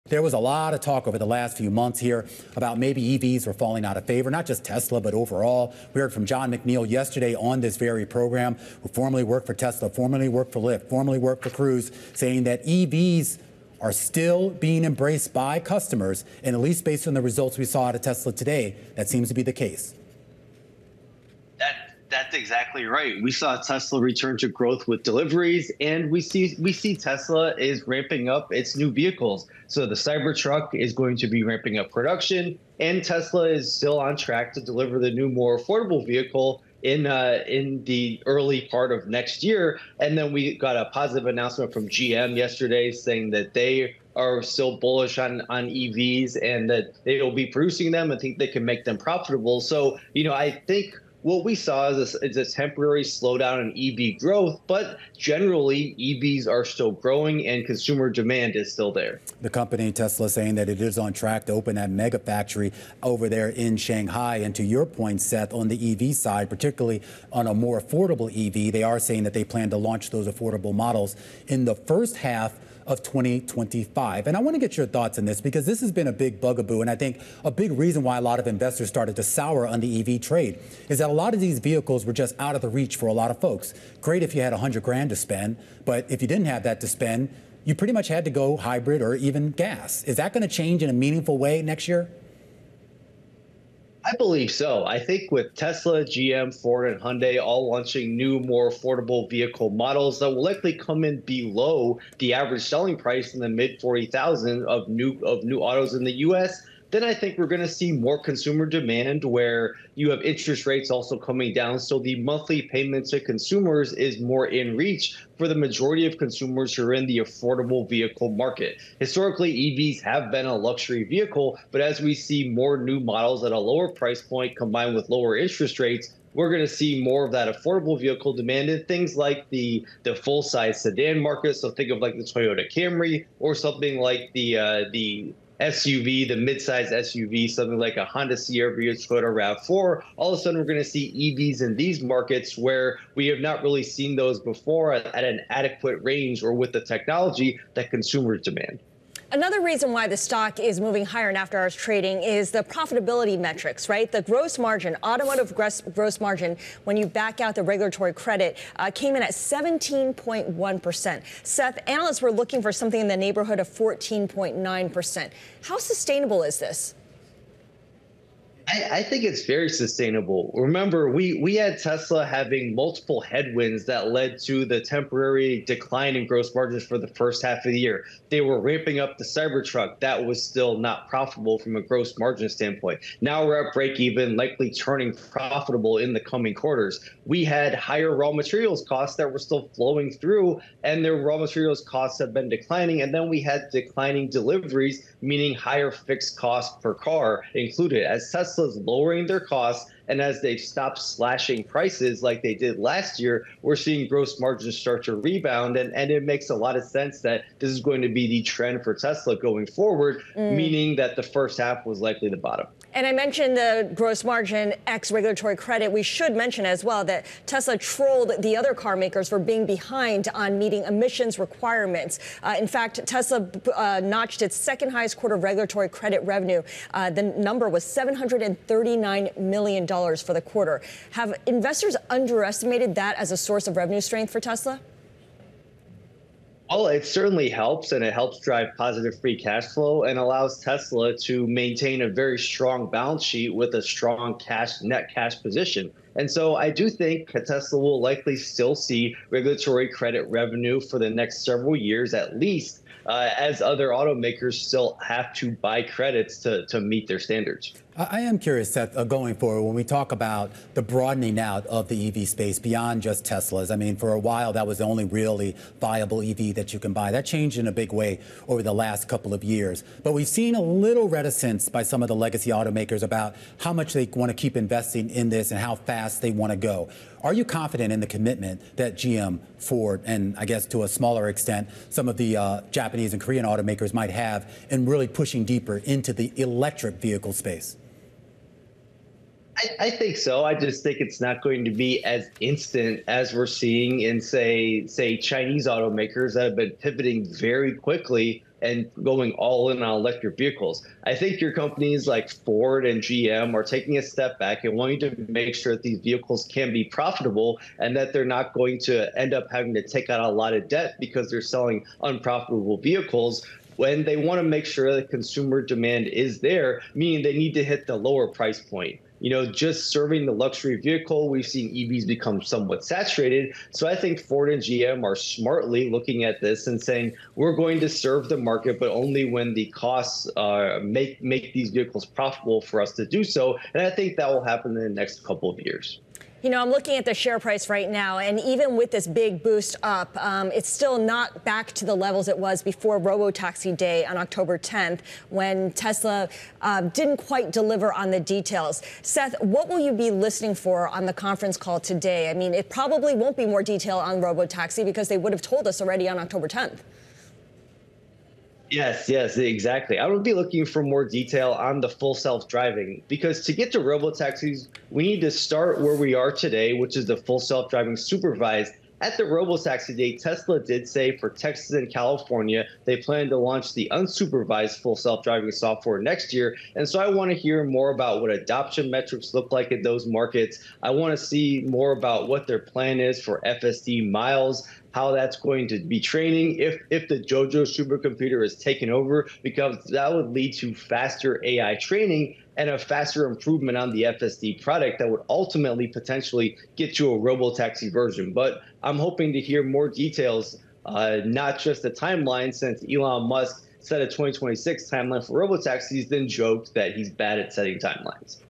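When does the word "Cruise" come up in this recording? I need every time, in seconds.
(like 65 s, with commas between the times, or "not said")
11 s.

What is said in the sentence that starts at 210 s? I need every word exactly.
meaning that the first half was likely the bottom.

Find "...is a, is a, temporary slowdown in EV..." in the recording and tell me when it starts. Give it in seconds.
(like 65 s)
51 s.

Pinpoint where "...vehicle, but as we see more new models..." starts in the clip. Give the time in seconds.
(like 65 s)
121 s.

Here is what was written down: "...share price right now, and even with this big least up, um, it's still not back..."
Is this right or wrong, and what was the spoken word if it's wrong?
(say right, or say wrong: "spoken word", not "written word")
wrong: "boost", not "least".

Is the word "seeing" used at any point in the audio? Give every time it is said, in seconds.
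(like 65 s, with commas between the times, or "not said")
203 s, 293 s.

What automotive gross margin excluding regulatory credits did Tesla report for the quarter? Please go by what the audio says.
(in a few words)
17.1%.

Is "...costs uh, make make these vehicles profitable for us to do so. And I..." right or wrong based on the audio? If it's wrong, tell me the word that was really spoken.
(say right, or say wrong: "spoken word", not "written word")
right.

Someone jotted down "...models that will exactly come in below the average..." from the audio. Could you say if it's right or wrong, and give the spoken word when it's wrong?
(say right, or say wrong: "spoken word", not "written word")
wrong: "likely", not "exactly".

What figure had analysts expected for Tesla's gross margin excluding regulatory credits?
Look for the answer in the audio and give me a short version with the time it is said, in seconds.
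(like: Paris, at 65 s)
14.9%, at 163 s.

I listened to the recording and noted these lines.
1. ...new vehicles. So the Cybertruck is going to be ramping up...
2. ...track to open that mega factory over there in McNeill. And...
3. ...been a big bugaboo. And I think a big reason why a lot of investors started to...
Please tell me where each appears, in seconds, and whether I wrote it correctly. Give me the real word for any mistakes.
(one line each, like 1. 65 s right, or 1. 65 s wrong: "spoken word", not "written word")
1. 28 s right
2. 61 s wrong: "Shanghai", not "McNeill"
3. 75 s right.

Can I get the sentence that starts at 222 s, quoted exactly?
Uh, in fact, Tesla uh, notched its second highest quarter of regulatory credit revenue.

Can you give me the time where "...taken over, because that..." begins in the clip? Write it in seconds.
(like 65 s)
388 s.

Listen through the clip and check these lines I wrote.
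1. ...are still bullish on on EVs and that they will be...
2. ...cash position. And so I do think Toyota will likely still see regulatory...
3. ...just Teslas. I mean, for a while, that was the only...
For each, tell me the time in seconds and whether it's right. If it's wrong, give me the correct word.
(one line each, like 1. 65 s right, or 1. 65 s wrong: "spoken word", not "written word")
1. 44 s right
2. 245 s wrong: "Tesla", not "Toyota"
3. 263 s right.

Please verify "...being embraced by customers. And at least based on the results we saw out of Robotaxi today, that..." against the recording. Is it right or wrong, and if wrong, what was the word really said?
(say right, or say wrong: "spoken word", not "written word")
wrong: "Tesla", not "Robotaxi".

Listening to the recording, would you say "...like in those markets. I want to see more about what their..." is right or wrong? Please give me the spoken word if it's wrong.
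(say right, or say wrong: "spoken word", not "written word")
right.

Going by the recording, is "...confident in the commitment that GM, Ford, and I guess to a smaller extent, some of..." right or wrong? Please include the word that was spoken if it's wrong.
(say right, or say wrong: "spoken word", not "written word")
right.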